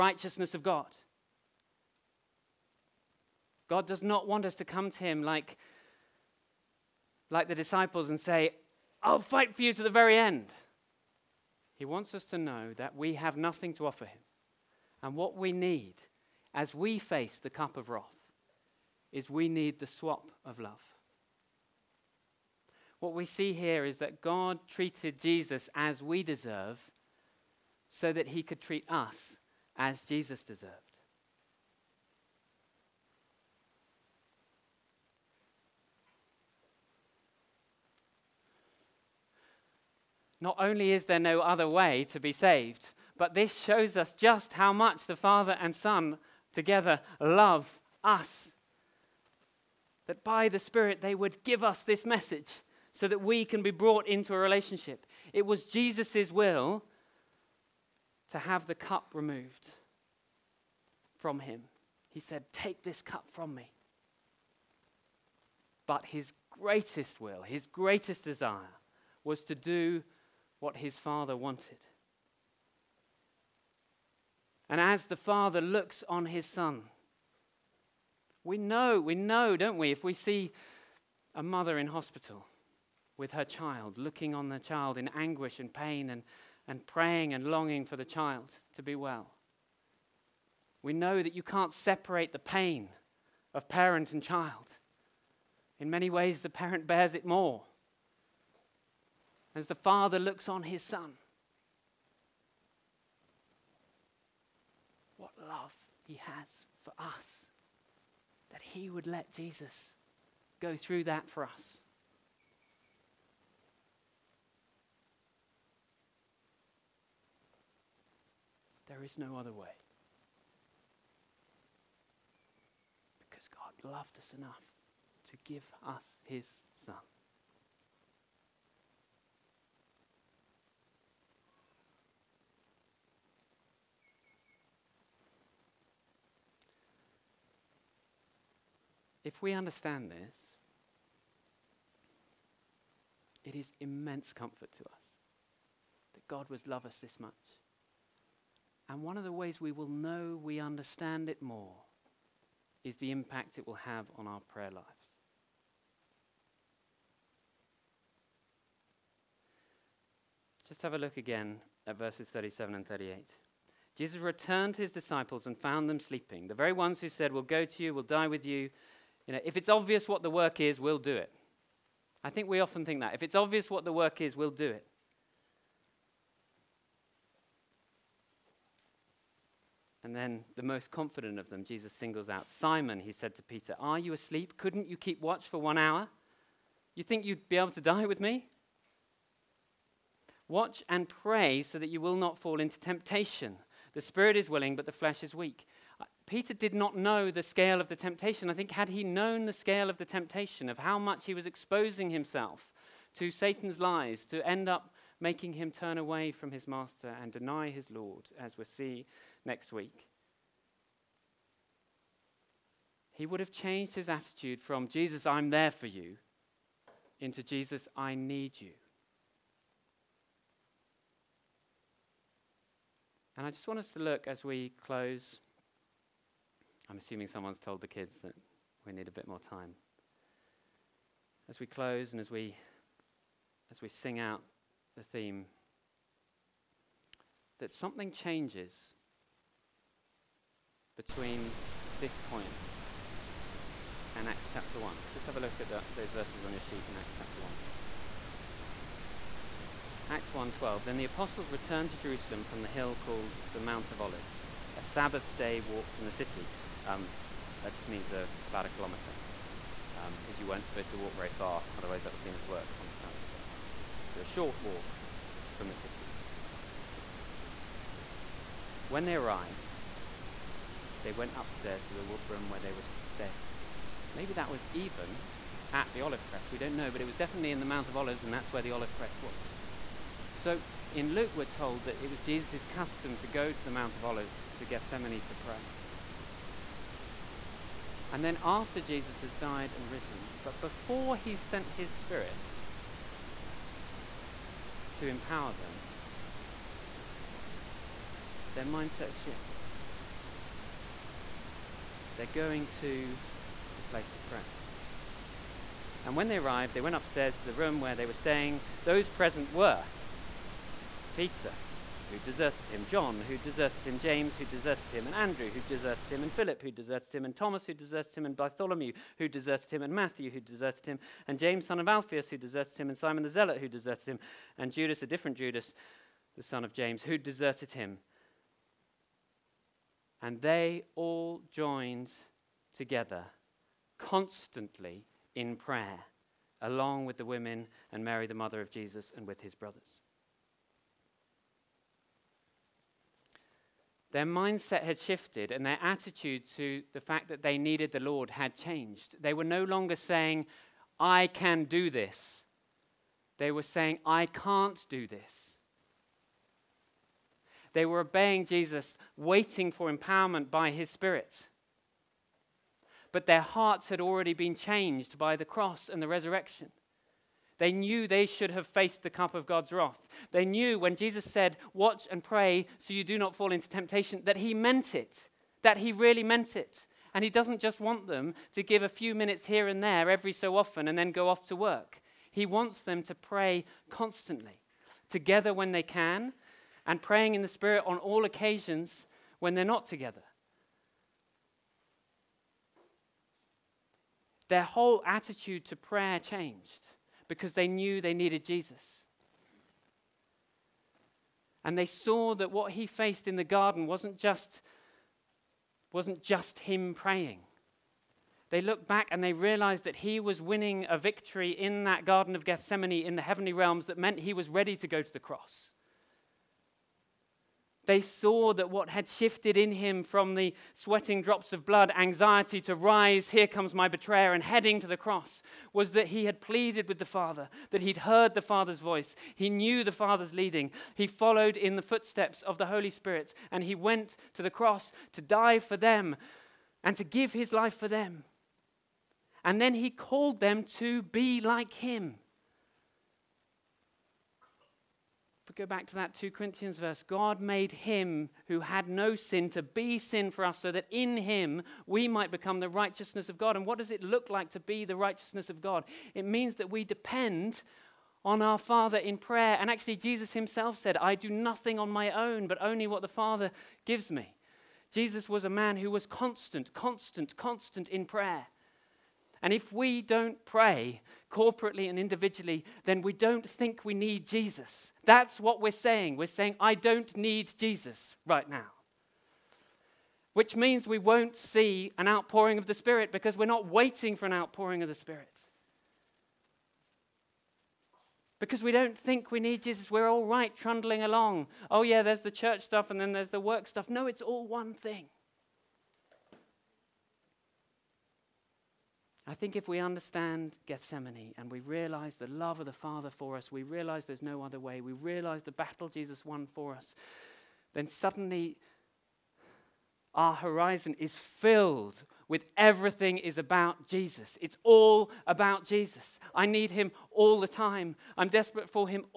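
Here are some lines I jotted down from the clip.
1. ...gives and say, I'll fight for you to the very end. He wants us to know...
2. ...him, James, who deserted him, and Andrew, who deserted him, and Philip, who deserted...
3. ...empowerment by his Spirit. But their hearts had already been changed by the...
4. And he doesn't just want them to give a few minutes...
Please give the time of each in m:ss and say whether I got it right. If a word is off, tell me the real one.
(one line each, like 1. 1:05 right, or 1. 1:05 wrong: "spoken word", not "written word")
1. 0:07 wrong: "disciples", not "gives"
2. 5:13 right
3. 5:59 right
4. 6:17 right.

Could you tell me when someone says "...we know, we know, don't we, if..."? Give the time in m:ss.
1:18.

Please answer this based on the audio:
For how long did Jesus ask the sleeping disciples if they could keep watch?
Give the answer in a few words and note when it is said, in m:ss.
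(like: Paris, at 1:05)
1 hour, at 3:05.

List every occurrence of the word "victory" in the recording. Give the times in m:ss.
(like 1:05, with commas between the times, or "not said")
6:50.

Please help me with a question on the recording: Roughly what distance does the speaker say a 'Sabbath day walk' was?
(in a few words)
About a kilometer.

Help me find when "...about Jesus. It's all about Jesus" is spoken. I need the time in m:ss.
8:33.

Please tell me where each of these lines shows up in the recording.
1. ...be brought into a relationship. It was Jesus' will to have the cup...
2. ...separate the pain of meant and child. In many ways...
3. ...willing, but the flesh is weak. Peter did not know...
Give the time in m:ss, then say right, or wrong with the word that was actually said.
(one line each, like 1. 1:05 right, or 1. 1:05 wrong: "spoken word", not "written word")
1. 0:53 right
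2. 1:31 wrong: "parent", not "meant"
3. 3:14 right.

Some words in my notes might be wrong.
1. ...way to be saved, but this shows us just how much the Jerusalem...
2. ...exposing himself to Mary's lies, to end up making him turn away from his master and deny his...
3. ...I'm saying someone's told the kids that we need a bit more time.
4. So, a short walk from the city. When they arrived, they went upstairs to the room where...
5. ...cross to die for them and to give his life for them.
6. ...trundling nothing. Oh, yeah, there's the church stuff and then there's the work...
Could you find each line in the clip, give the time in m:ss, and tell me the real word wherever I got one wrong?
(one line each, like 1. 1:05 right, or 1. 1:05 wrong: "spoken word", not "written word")
1. 0:41 wrong: "Father", not "Jerusalem"
2. 3:21 wrong: "Satan", not "Mary"
3. 3:46 wrong: "assuming", not "saying"
4. 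4:24 right
5. 7:14 right
6. 8:10 wrong: "along", not "nothing".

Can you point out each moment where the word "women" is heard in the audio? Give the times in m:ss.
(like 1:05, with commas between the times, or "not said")
5:37.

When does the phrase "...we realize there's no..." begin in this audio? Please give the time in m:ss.
8:23.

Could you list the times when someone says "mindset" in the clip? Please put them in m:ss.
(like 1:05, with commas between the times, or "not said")
4:58, 5:44.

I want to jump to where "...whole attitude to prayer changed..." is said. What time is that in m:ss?
6:34.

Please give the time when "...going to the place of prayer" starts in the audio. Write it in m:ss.
5:02.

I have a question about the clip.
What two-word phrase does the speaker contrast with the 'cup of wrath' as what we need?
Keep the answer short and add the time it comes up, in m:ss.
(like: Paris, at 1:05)
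The swap of love, at 0:19.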